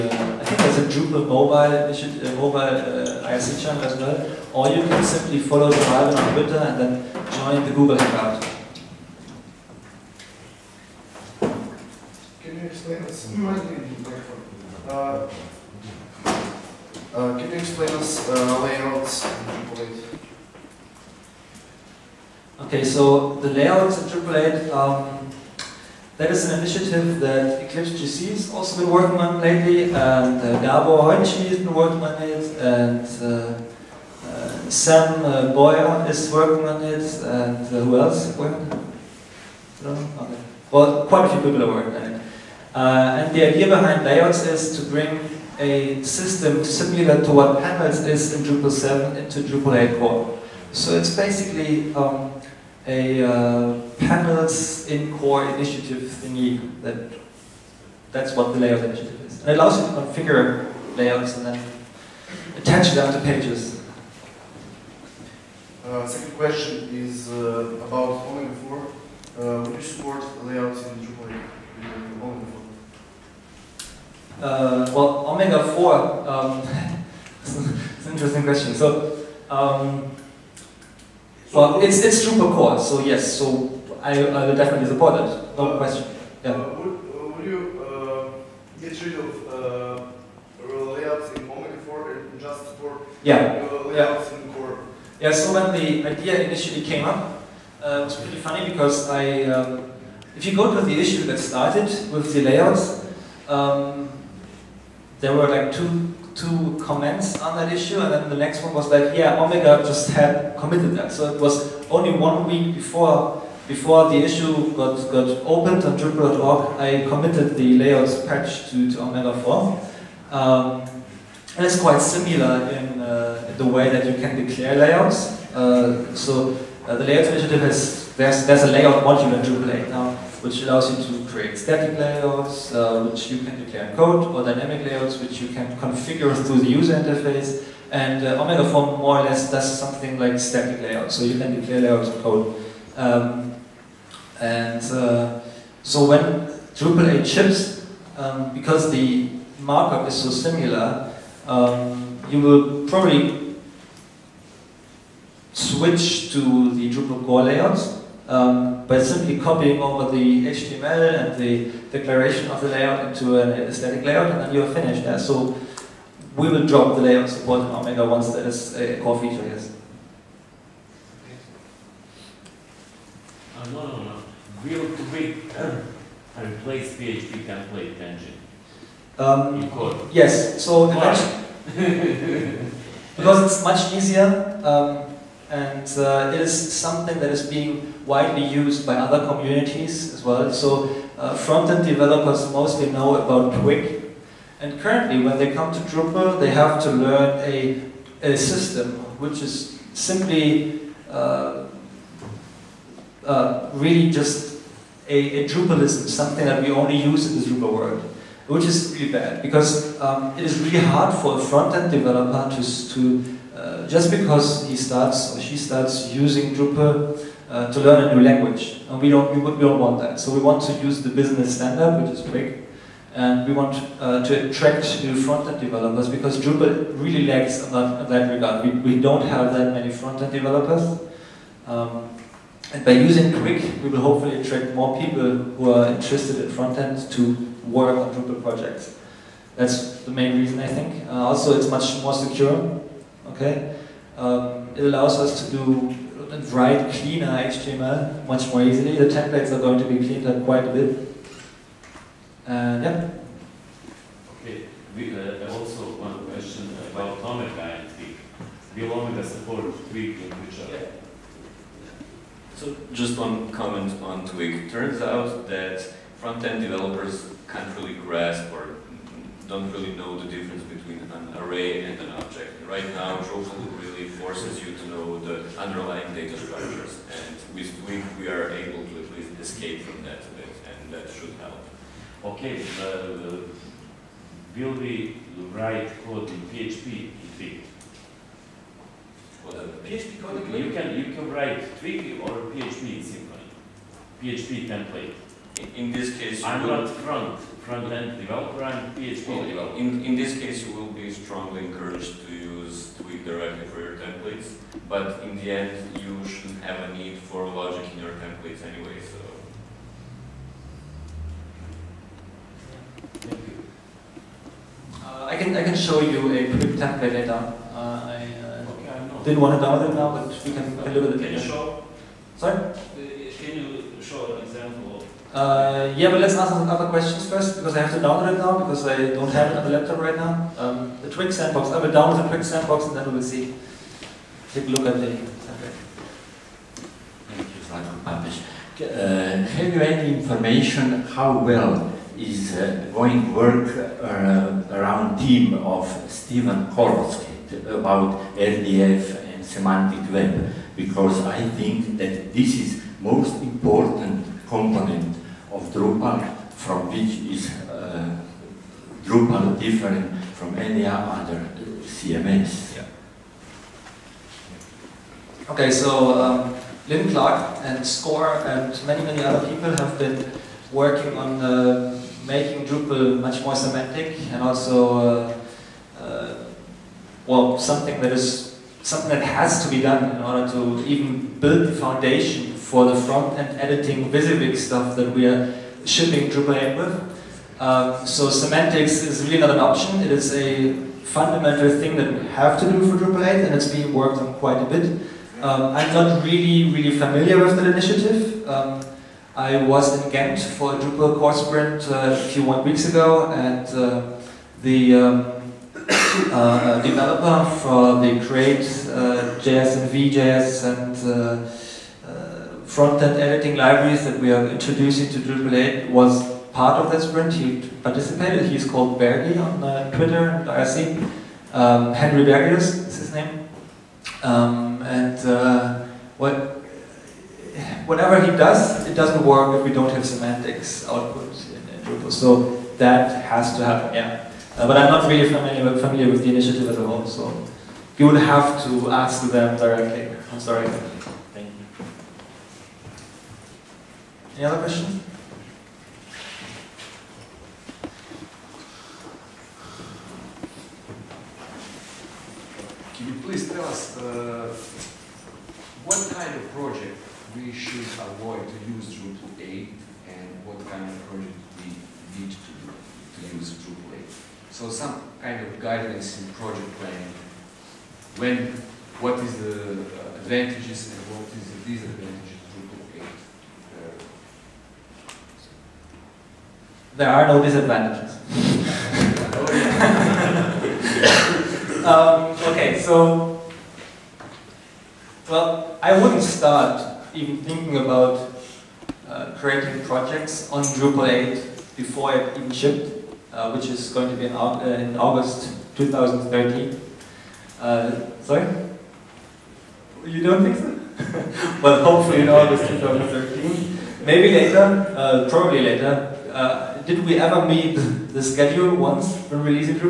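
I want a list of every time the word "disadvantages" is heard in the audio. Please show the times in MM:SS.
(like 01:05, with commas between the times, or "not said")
07:51, 07:57.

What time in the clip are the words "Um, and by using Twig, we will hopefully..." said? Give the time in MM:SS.
03:51.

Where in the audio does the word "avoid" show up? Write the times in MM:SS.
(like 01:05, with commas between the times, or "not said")
07:37.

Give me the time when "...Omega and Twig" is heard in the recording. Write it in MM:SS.
04:17.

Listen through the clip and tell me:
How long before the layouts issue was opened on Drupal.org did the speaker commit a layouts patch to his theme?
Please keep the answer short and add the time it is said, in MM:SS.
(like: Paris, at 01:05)
One week, at 01:52.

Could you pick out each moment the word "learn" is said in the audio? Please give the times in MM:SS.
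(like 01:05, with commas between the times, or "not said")
03:16, 03:37.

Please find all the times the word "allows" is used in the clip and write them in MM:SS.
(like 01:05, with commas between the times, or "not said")
00:59, 02:10, 04:04.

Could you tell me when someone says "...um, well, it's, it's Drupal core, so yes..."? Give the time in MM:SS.
01:19.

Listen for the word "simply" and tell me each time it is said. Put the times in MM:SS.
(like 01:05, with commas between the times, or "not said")
00:05, 02:39, 03:19.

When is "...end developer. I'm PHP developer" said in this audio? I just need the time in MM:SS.
04:57.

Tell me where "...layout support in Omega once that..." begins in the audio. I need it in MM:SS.
02:47.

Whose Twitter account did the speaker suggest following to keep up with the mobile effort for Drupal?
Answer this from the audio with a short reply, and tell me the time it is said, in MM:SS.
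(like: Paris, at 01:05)
John Albin, at 00:05.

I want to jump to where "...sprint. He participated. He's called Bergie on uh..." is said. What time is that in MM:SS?
06:57.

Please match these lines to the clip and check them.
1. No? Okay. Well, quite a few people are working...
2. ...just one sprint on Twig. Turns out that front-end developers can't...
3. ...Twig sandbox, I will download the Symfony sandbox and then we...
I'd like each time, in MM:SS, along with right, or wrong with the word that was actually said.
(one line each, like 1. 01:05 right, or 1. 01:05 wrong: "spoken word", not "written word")
1. 00:39 right
2. 04:22 wrong: "comment", not "sprint"
3. 05:31 wrong: "Twig", not "Symfony".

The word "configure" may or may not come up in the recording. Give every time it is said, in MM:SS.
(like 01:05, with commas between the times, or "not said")
01:00, 02:15.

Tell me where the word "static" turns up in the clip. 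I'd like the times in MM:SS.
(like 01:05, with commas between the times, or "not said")
02:11, 02:20.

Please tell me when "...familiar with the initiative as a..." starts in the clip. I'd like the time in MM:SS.
07:15.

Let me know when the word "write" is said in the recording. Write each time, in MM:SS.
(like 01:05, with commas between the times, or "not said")
04:06, 04:45, 04:51.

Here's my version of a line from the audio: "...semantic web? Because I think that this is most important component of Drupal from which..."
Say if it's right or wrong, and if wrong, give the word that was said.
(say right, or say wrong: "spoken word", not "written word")
right.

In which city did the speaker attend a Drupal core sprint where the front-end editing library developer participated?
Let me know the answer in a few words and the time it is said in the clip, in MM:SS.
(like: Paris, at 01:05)
Ghent, at 06:40.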